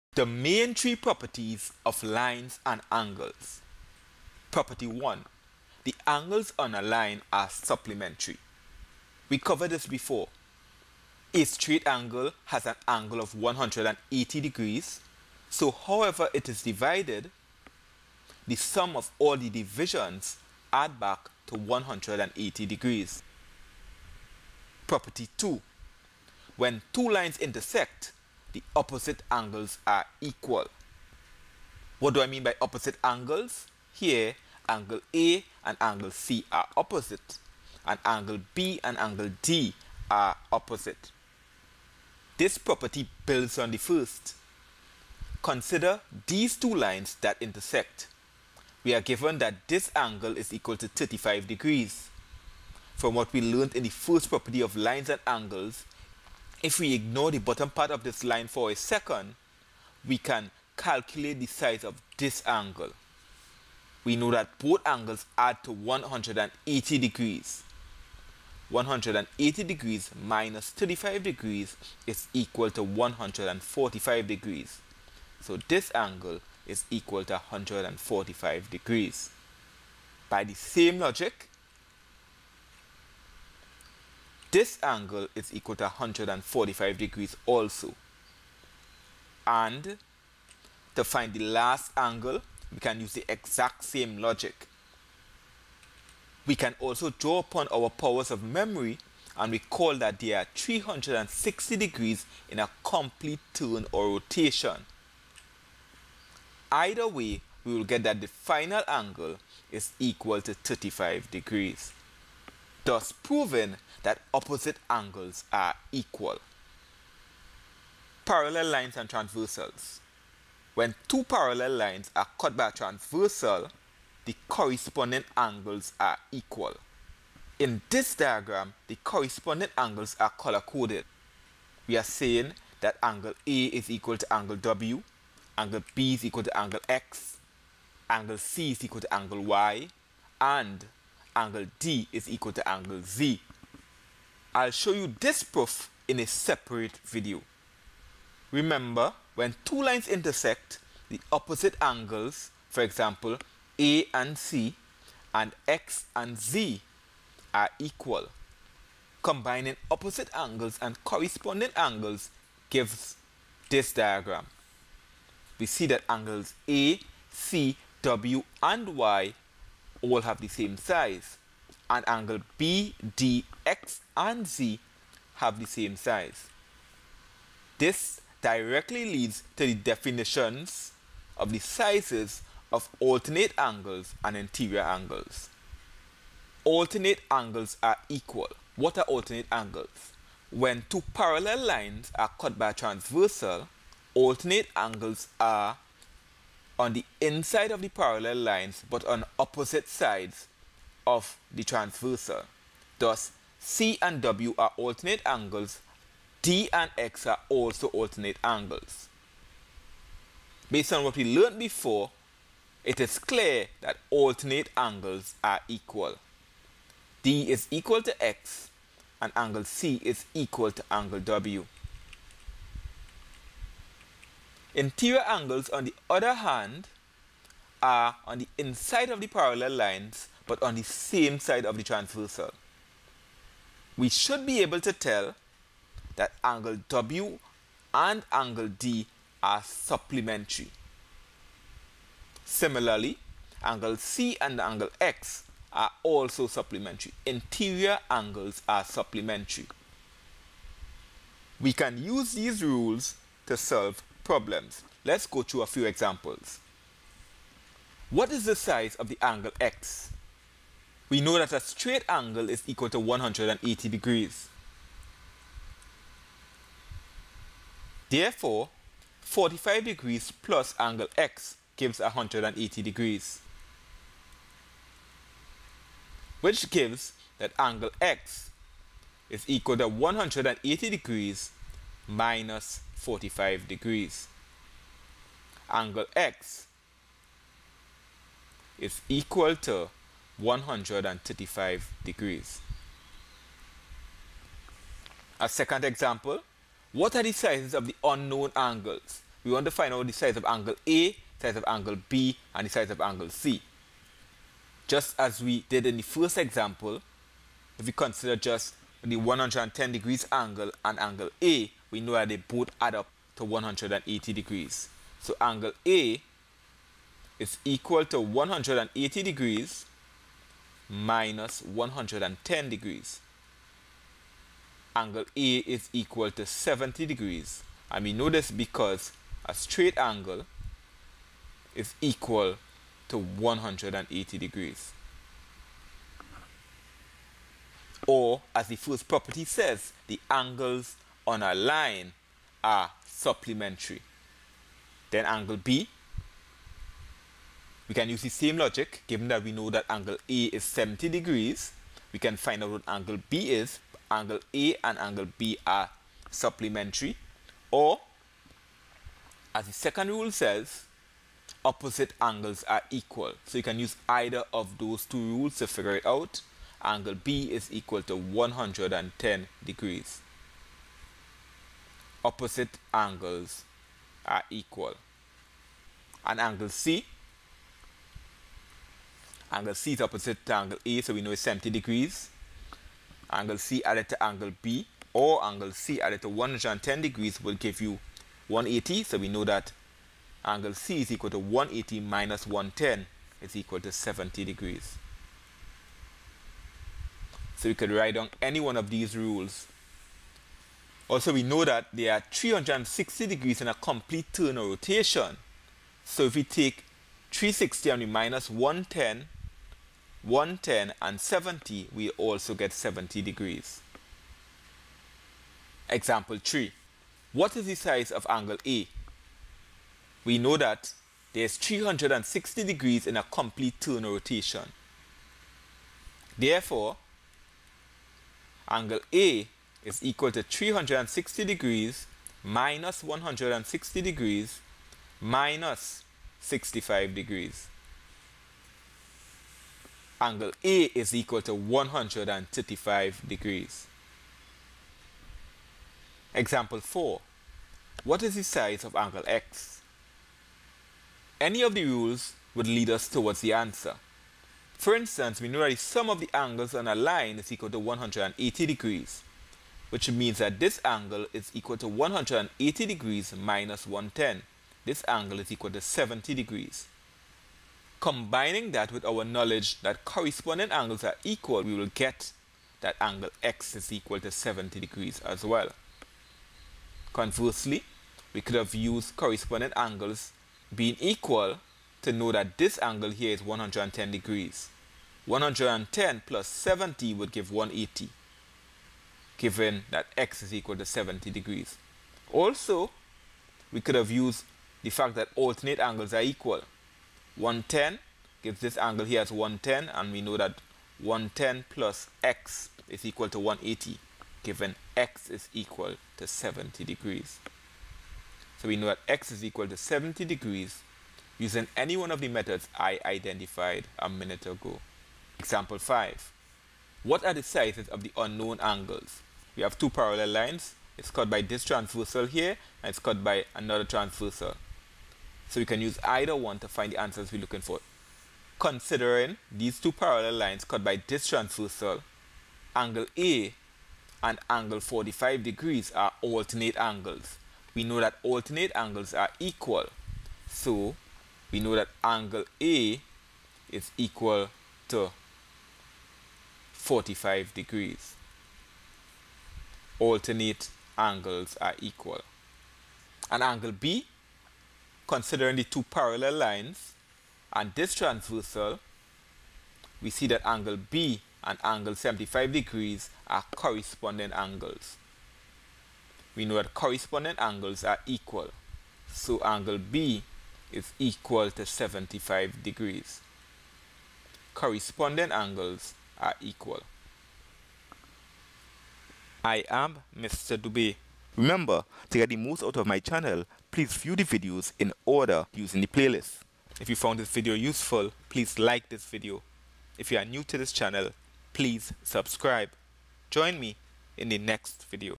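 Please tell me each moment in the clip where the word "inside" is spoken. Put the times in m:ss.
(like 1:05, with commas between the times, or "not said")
3:17, 3:48.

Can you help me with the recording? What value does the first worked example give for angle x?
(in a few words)
135 degrees.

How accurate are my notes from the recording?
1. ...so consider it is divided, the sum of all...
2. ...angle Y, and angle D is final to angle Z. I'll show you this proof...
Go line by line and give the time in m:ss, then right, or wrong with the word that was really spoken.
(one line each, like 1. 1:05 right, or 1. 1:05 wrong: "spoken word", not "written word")
1. 0:15 wrong: "however", not "consider"
2. 2:19 wrong: "equal", not "final".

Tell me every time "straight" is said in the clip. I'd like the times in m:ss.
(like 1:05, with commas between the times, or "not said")
0:11, 4:21, 5:29.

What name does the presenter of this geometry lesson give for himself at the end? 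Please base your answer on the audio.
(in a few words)
Mr. Dube.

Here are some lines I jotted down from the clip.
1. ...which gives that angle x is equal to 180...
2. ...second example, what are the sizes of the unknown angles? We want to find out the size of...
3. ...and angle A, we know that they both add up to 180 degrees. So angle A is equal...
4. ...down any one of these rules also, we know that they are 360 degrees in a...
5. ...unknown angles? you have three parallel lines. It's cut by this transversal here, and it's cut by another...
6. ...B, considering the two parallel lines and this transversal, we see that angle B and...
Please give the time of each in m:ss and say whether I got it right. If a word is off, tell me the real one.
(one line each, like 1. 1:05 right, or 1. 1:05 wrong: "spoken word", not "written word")
1. 4:36 right
2. 4:55 right
3. 5:10 right
4. 6:38 right
5. 8:38 wrong: "two", not "three"
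6. 9:13 right.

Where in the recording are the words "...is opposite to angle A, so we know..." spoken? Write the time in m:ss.
6:19.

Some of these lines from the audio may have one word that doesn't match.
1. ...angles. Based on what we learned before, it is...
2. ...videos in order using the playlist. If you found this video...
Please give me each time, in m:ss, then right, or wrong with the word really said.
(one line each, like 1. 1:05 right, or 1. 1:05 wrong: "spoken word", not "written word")
1. 3:28 right
2. 9:44 right.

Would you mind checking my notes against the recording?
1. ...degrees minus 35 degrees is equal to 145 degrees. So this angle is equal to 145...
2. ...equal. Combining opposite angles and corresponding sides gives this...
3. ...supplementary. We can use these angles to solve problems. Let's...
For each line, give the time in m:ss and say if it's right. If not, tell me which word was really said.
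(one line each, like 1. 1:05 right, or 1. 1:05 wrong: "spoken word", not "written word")
1. 1:09 right
2. 2:37 wrong: "angles", not "sides"
3. 4:08 wrong: "rules", not "angles".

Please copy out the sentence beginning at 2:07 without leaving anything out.
In this diagram, the corresponding angles are color-coded.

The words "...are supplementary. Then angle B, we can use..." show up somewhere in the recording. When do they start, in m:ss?
5:42.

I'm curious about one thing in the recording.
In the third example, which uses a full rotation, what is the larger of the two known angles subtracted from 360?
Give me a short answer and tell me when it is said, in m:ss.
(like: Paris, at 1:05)
160 degrees, at 7:13.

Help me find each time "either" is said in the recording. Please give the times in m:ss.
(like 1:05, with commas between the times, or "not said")
1:46, 6:04, 8:46.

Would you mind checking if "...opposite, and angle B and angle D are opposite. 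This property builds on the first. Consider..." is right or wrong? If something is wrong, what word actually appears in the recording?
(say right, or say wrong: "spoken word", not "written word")
right.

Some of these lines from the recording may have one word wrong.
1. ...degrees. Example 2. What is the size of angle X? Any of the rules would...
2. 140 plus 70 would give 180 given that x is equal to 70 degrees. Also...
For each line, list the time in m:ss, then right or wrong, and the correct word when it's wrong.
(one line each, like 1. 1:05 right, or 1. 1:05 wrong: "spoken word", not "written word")
1. 7:23 wrong: "4", not "2"
2. 8:05 wrong: "110", not "140".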